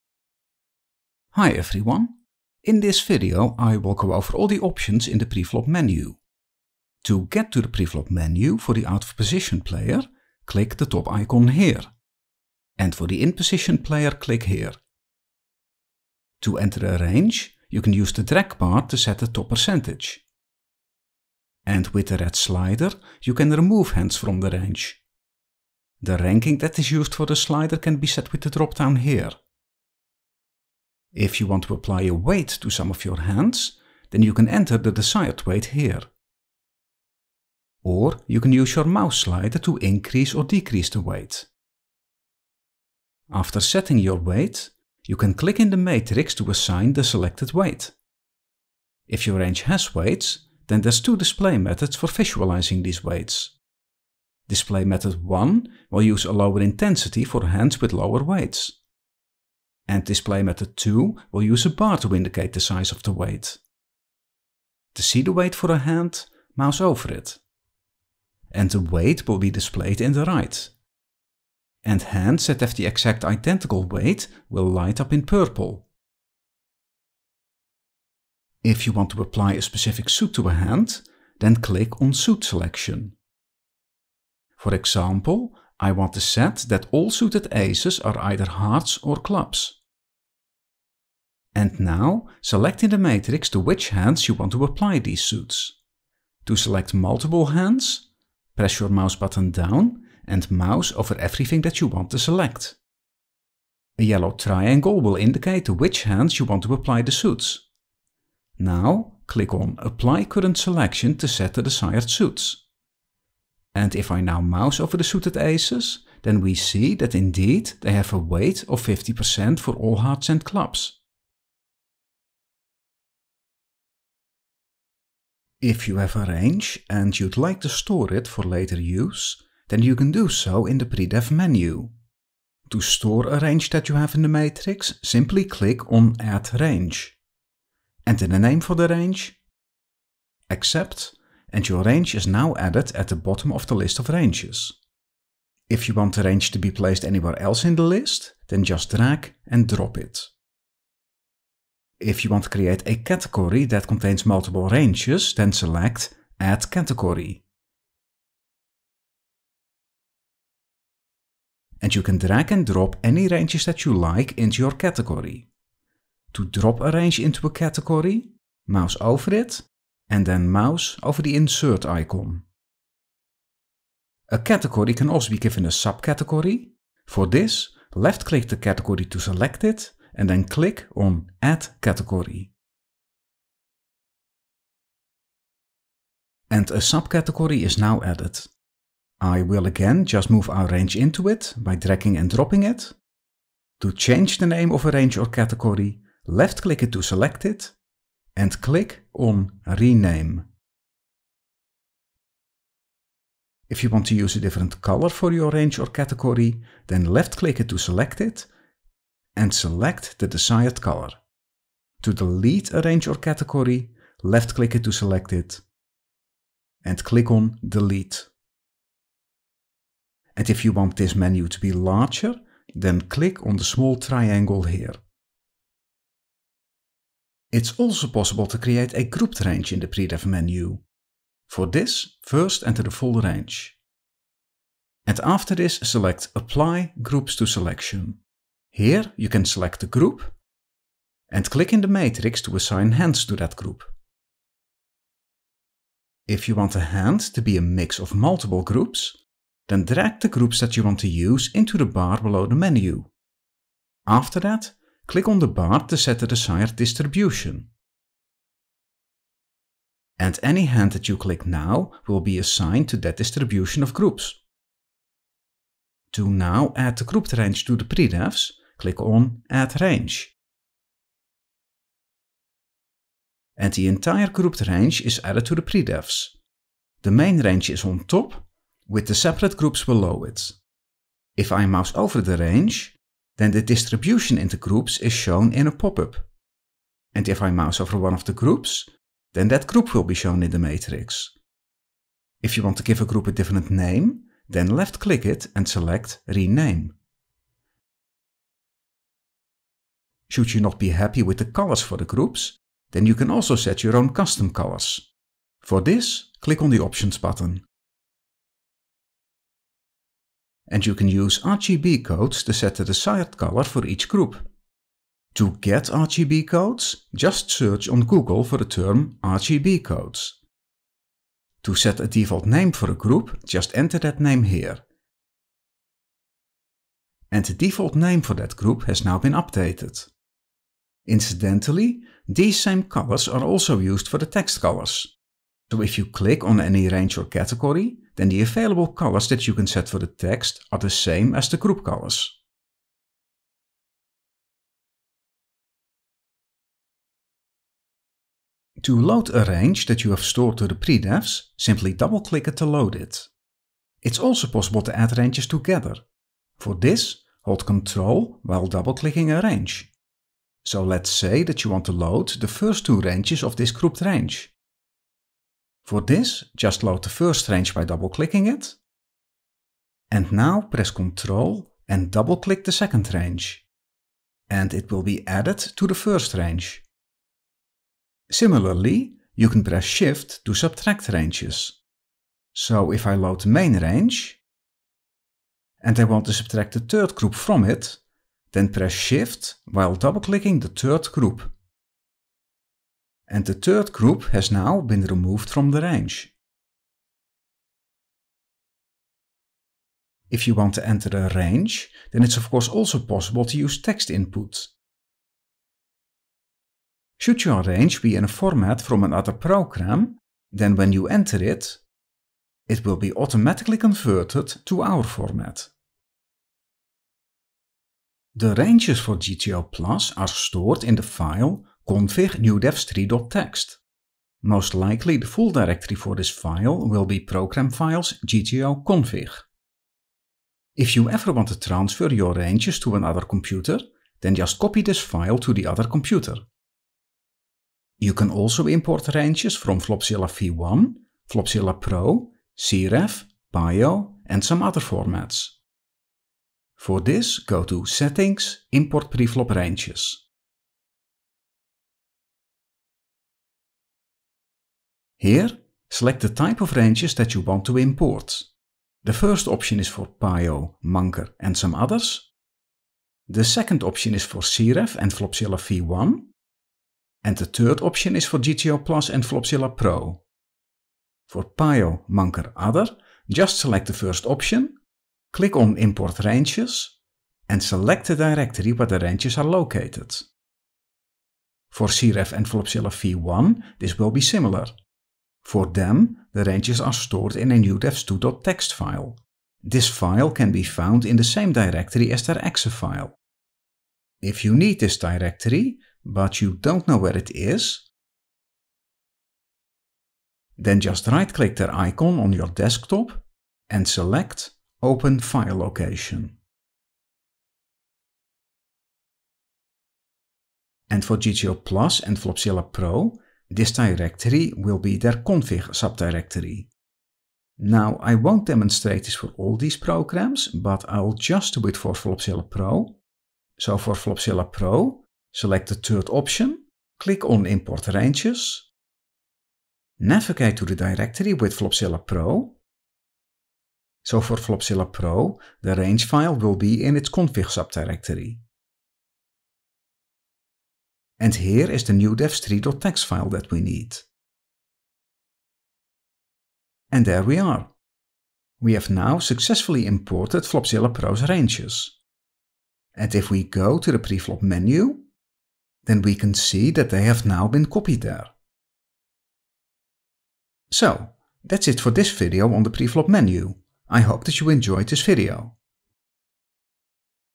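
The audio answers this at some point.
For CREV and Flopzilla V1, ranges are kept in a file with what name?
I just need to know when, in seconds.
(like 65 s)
487 s.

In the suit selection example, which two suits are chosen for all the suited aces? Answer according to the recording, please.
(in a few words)
hearts or clubs.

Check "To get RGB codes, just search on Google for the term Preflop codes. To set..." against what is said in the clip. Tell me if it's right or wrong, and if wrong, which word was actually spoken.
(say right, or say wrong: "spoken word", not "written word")
wrong: "RGB", not "Preflop".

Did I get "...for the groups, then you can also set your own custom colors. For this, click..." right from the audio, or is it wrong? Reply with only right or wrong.
right.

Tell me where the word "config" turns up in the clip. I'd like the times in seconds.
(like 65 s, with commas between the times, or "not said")
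421 s, 428 s, 515 s, 537 s.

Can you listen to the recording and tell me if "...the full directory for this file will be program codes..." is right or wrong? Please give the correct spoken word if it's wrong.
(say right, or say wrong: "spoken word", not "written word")
wrong: "files", not "codes".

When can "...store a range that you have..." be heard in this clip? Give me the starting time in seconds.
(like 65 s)
132 s.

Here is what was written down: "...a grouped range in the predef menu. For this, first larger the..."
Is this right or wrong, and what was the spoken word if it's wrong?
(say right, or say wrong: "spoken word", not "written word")
wrong: "enter", not "larger".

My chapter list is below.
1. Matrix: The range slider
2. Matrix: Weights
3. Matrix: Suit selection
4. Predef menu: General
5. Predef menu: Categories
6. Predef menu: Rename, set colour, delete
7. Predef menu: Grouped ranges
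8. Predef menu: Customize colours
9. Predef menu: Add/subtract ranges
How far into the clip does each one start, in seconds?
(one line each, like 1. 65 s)
1. 17 s
2. 30 s
3. 78 s
4. 124 s
5. 152 s
6. 195 s
7. 227 s
8. 300 s
9. 346 s.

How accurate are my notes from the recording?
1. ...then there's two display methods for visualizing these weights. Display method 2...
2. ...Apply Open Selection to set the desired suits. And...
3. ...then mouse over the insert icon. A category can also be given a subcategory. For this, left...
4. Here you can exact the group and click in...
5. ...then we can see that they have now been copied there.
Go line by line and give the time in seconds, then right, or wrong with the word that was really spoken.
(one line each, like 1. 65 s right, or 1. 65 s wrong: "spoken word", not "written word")
1. 50 s wrong: "1", not "2"
2. 109 s wrong: "Current", not "Open"
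3. 170 s right
4. 238 s wrong: "select", not "exact"
5. 555 s right.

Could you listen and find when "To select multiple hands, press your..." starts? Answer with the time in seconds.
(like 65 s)
96 s.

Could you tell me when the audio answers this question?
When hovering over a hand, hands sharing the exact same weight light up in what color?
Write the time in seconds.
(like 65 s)
75 s.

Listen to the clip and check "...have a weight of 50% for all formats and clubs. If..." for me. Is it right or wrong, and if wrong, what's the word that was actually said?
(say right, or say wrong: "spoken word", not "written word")
wrong: "hearts", not "formats".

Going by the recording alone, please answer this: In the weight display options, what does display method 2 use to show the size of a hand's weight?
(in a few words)
a bar.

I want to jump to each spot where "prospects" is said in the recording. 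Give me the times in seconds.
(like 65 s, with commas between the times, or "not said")
not said.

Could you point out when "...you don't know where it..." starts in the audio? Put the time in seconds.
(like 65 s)
496 s.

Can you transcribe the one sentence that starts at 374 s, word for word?
And it will be added to the first range.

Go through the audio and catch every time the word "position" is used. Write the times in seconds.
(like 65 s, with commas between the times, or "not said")
9 s, 13 s.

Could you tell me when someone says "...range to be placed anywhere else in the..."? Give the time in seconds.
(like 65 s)
146 s.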